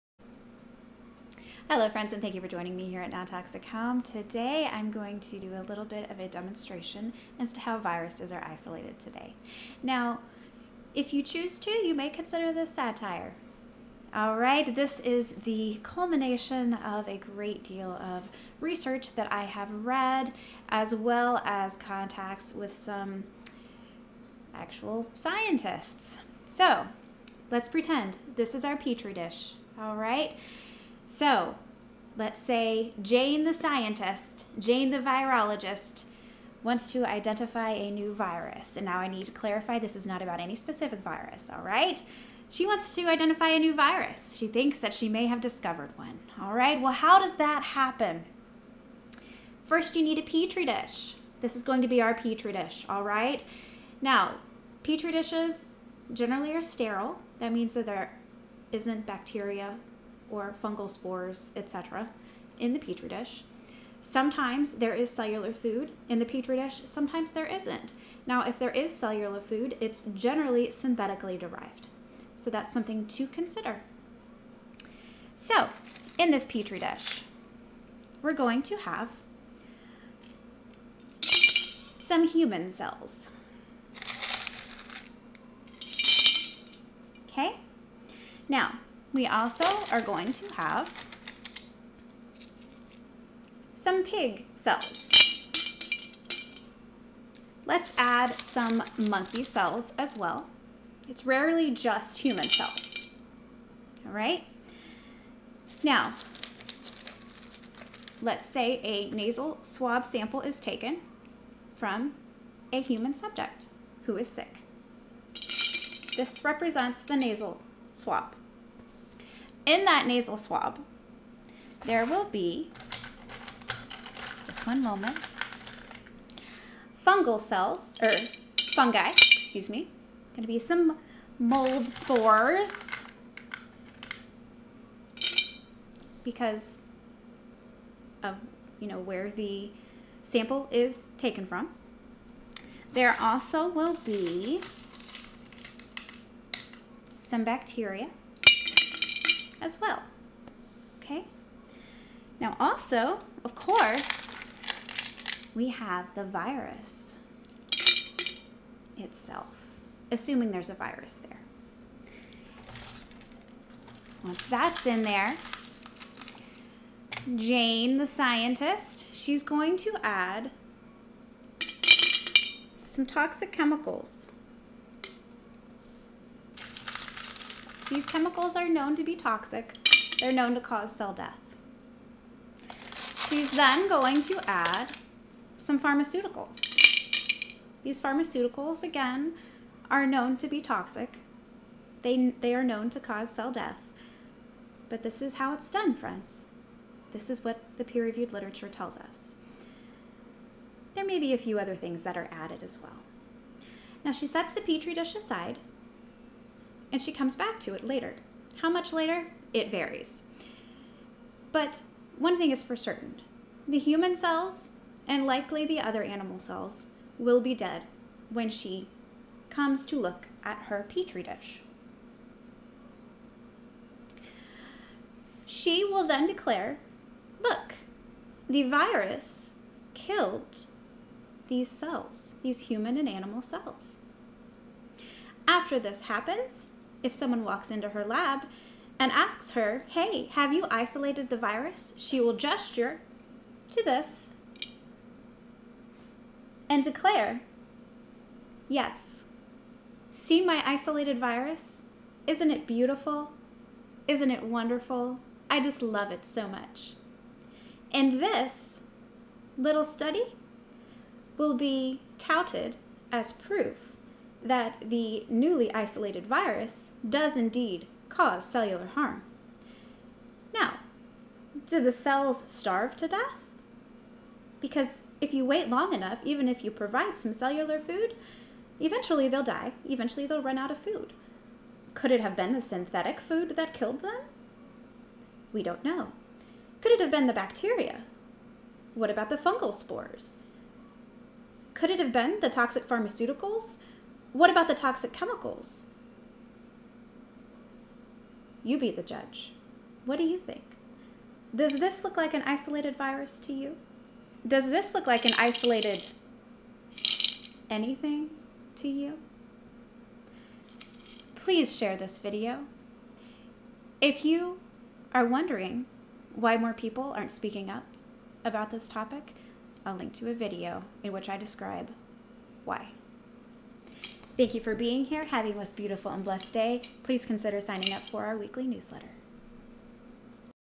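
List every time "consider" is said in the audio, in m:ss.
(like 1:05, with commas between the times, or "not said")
0:12, 1:13, 5:27.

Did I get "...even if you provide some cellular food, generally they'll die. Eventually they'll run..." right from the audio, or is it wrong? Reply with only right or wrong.
wrong.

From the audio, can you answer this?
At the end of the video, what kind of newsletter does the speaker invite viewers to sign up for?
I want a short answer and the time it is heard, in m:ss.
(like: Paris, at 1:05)
Weekly, at 5:28.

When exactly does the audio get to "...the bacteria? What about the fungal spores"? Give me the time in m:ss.
4:47.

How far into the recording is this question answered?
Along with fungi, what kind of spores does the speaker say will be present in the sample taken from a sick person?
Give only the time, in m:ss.
2:11.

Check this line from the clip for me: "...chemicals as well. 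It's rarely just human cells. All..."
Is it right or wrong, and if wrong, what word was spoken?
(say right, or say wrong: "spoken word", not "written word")
wrong: "cells", not "chemicals".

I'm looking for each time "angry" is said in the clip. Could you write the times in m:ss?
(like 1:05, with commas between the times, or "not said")
not said.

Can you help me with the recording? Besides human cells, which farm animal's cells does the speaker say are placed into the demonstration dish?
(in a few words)
Pig.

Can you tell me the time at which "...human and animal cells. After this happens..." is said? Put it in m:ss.
3:52.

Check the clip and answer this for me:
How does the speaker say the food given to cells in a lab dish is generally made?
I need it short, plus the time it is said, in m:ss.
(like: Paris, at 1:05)
Synthetically derived, at 1:10.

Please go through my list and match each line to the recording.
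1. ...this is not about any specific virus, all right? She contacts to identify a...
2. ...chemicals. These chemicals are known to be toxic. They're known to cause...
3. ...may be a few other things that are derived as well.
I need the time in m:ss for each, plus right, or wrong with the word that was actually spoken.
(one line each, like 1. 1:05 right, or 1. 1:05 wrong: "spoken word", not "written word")
1. 0:39 wrong: "wants", not "contacts"
2. 2:53 right
3. 3:21 wrong: "added", not "derived".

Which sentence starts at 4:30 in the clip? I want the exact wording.
Now, do the cells starve to death?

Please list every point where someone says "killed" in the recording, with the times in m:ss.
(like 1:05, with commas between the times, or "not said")
3:49, 4:43.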